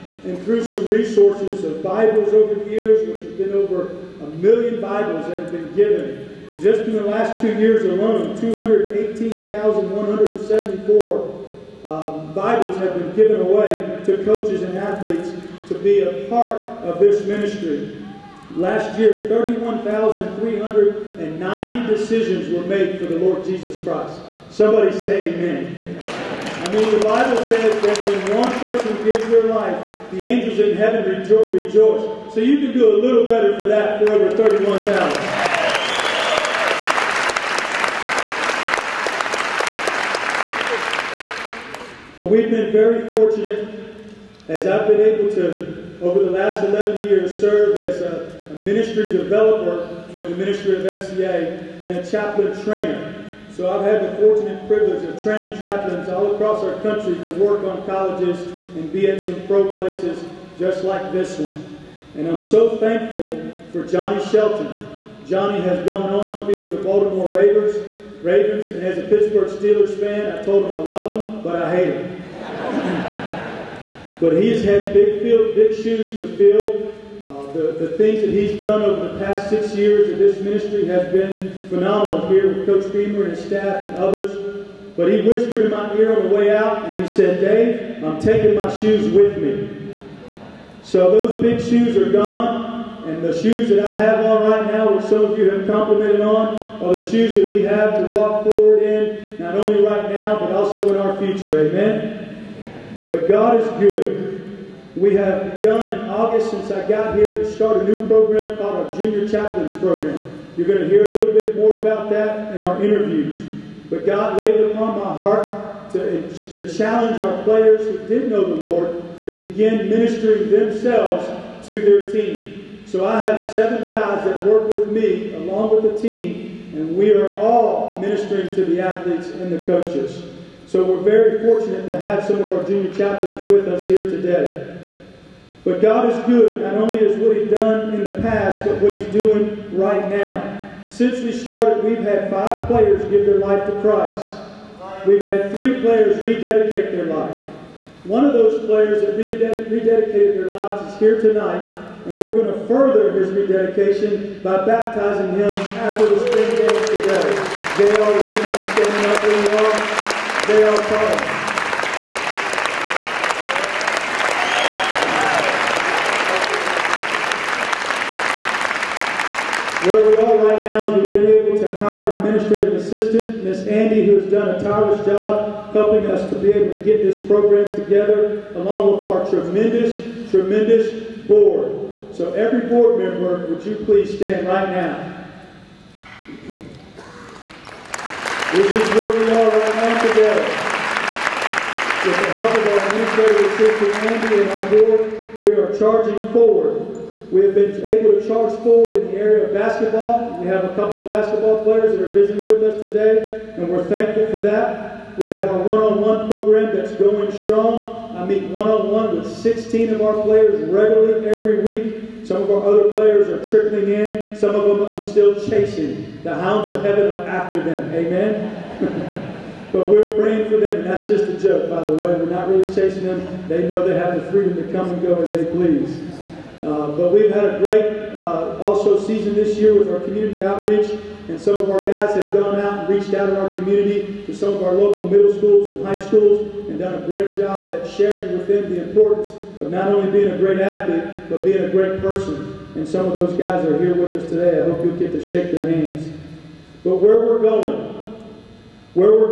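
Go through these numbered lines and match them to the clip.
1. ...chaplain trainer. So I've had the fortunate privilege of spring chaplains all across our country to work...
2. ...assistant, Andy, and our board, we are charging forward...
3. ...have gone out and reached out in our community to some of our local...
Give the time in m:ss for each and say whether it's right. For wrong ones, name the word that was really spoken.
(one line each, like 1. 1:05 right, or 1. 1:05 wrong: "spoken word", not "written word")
1. 0:52 wrong: "training", not "spring"
2. 3:13 right
3. 3:52 right.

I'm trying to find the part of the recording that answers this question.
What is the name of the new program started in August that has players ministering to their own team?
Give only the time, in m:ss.
1:48.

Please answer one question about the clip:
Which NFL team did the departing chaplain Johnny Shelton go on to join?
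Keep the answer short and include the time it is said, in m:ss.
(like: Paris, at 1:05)
Baltimore Ravens, at 1:06.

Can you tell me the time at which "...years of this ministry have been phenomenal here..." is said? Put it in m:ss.
1:19.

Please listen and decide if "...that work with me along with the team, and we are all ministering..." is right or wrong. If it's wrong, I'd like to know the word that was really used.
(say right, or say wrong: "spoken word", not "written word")
right.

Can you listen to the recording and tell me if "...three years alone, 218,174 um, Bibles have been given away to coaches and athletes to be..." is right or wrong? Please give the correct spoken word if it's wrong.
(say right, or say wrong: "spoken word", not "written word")
wrong: "two", not "three".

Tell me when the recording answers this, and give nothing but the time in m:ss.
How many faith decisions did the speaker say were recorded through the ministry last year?
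0:19.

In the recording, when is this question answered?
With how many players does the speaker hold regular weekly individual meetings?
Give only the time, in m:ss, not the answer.
3:29.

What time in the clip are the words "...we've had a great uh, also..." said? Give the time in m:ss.
3:47.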